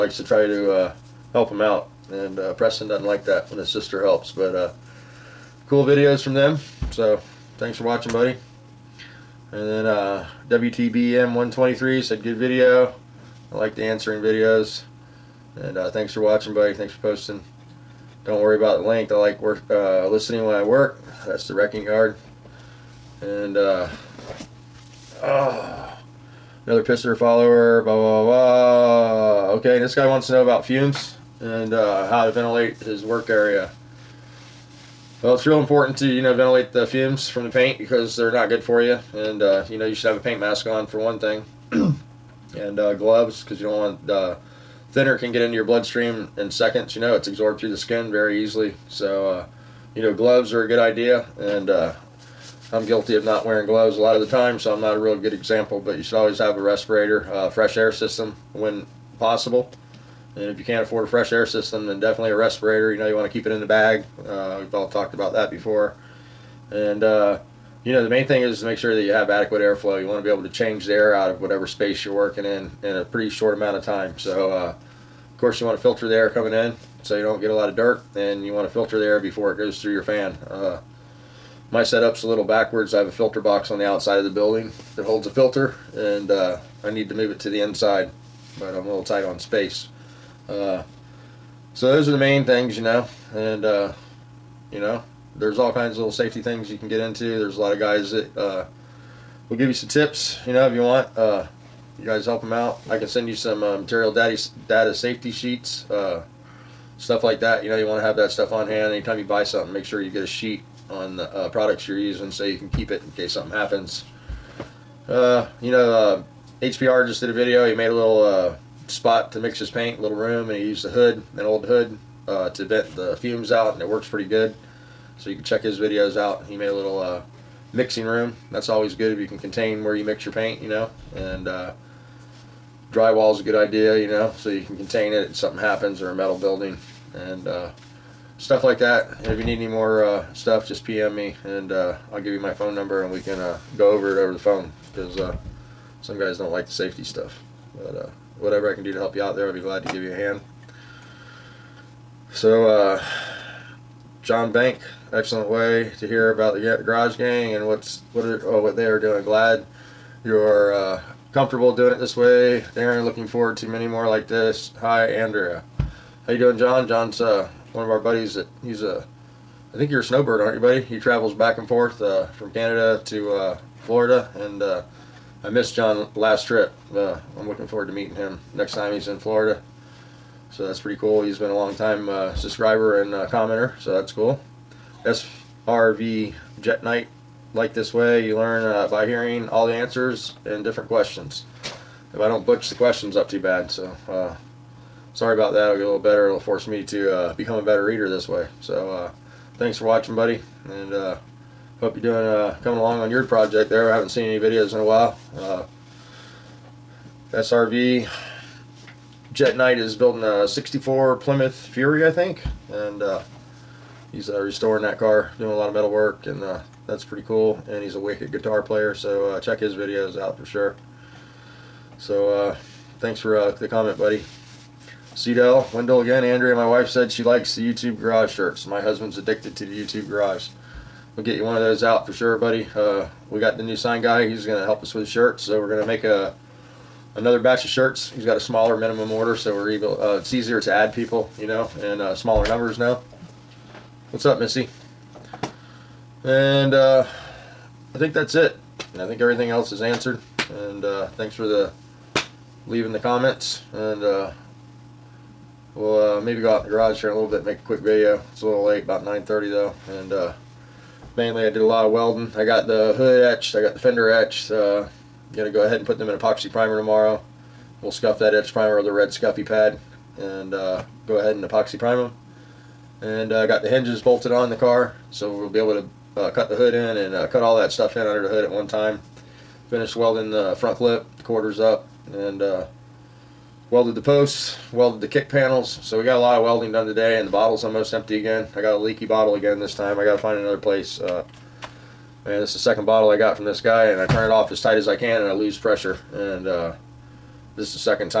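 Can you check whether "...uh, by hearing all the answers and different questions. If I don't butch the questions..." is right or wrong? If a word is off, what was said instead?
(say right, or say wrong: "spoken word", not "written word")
right.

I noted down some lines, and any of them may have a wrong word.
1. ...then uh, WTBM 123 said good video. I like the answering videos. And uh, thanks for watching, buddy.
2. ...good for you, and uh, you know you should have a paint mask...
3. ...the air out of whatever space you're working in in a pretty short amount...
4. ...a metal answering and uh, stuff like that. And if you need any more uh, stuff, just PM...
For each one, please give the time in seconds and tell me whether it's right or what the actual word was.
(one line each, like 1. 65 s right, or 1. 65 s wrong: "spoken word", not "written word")
1. 9 s right
2. 38 s right
3. 70 s right
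4. 136 s wrong: "building", not "answering".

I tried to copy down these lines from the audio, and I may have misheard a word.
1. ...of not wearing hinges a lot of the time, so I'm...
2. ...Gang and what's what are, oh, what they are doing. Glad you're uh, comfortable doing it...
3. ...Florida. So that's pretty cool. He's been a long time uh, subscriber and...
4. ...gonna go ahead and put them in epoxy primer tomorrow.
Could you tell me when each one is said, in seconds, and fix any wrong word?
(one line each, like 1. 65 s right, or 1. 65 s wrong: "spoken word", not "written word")
1. 53 s wrong: "gloves", not "hinges"
2. 157 s right
3. 179 s right
4. 265 s right.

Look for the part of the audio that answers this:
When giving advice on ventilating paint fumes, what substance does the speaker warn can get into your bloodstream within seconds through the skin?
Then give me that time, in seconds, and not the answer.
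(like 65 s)
44 s.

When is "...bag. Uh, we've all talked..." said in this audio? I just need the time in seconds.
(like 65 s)
63 s.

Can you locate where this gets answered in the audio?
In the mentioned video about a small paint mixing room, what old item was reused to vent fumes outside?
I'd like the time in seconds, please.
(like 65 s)
121 s.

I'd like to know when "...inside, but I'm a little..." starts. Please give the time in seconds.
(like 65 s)
87 s.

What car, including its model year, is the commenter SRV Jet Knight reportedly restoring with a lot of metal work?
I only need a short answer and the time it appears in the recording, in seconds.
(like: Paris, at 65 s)
64 Plymouth Fury, at 210 s.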